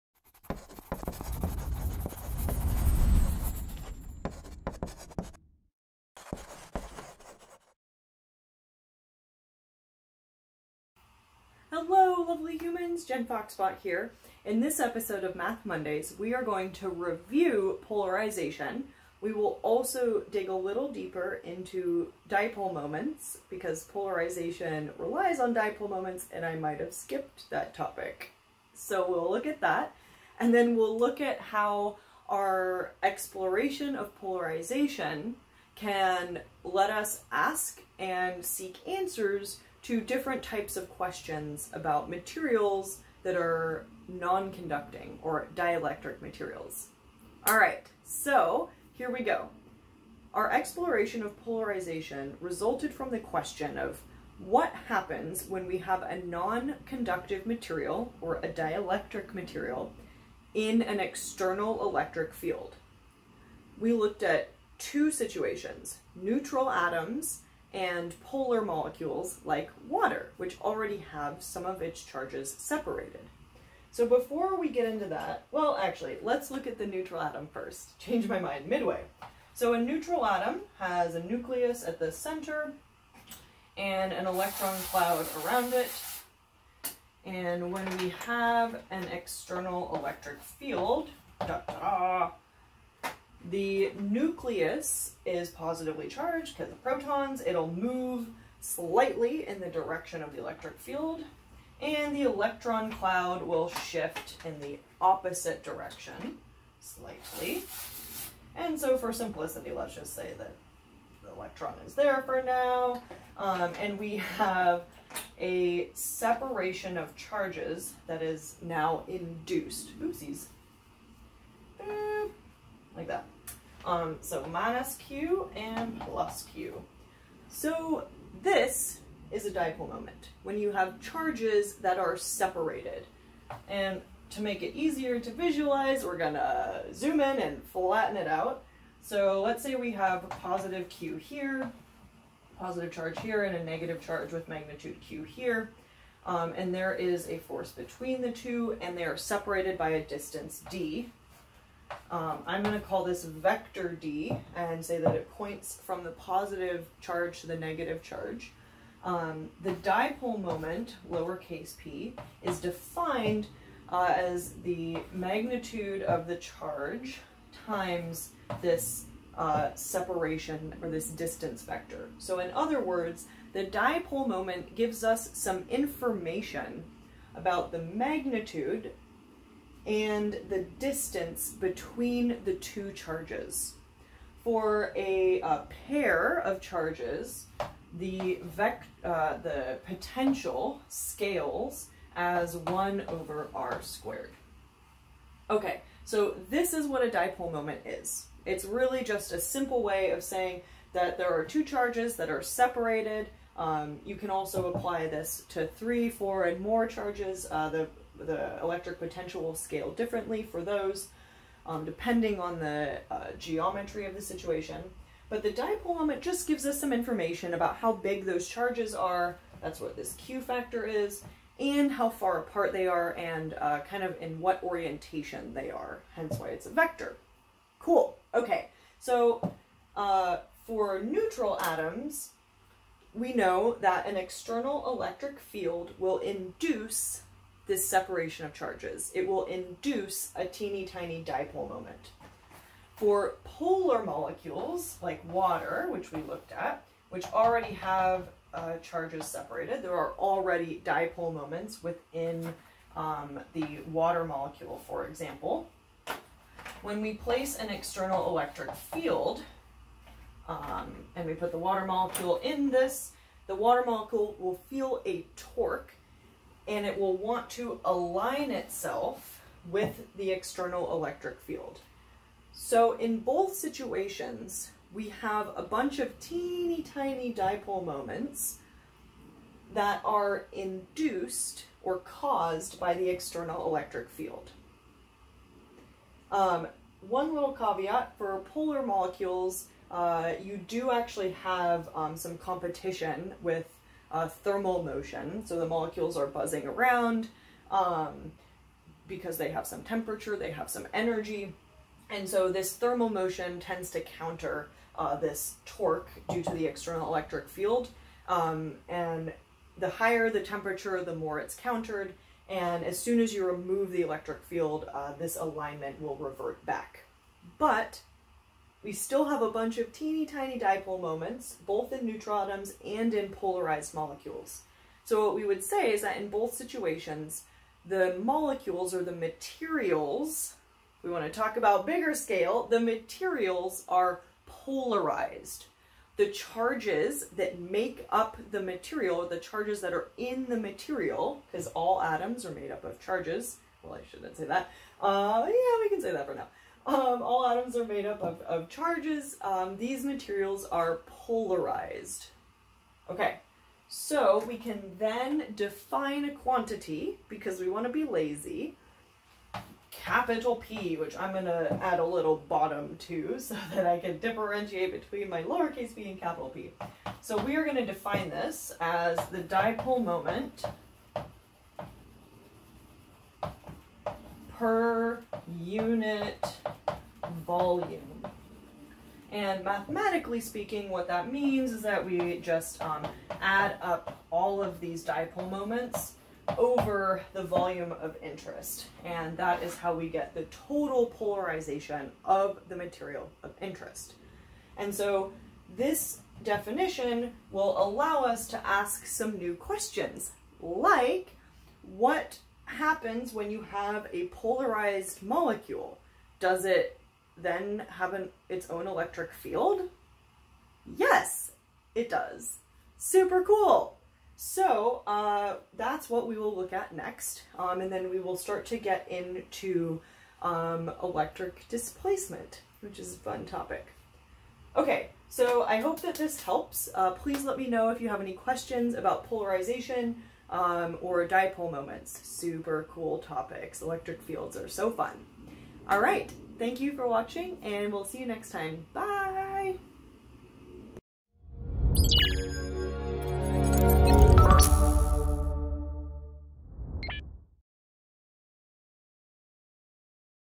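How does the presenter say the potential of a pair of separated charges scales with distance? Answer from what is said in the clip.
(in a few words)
1 over r squared.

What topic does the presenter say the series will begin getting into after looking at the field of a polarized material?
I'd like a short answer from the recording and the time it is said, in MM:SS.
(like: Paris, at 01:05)
electric displacement, at 07:01.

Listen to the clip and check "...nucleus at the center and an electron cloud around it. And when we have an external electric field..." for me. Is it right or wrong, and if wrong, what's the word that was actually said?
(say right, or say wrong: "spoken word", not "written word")
right.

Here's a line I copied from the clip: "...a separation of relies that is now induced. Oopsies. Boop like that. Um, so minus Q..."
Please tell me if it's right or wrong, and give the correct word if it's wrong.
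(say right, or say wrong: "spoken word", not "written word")
wrong: "charges", not "relies".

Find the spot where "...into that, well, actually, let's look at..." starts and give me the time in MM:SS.
01:14.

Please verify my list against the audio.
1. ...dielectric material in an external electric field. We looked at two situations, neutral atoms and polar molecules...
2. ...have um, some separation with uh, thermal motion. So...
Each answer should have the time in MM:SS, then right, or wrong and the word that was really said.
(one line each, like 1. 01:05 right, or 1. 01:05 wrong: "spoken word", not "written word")
1. 00:58 right
2. 04:51 wrong: "competition", not "separation".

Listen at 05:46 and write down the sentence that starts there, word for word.
Um, all atoms are made up of, of charges.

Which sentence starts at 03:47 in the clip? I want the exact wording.
Cool, okay, so uh, for neutral atoms, we know that an external electric field will induce this separation of charges.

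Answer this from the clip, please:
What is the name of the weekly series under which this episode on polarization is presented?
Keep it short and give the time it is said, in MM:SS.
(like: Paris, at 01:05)
Math Mondays, at 00:15.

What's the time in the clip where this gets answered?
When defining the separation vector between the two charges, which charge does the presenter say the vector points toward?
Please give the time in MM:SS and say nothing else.
02:37.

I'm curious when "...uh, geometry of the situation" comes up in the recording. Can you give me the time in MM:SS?
03:33.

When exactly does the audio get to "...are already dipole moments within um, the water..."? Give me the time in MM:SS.
04:09.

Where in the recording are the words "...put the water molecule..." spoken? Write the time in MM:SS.
04:21.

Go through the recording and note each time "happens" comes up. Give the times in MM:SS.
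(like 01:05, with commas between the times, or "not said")
00:54, 06:42.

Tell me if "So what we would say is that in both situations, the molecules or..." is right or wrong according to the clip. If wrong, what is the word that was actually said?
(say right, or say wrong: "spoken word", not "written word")
right.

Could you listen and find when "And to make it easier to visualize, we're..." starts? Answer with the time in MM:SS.
02:13.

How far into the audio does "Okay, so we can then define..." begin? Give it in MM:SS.
05:53.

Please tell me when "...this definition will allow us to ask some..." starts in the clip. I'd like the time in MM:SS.
06:35.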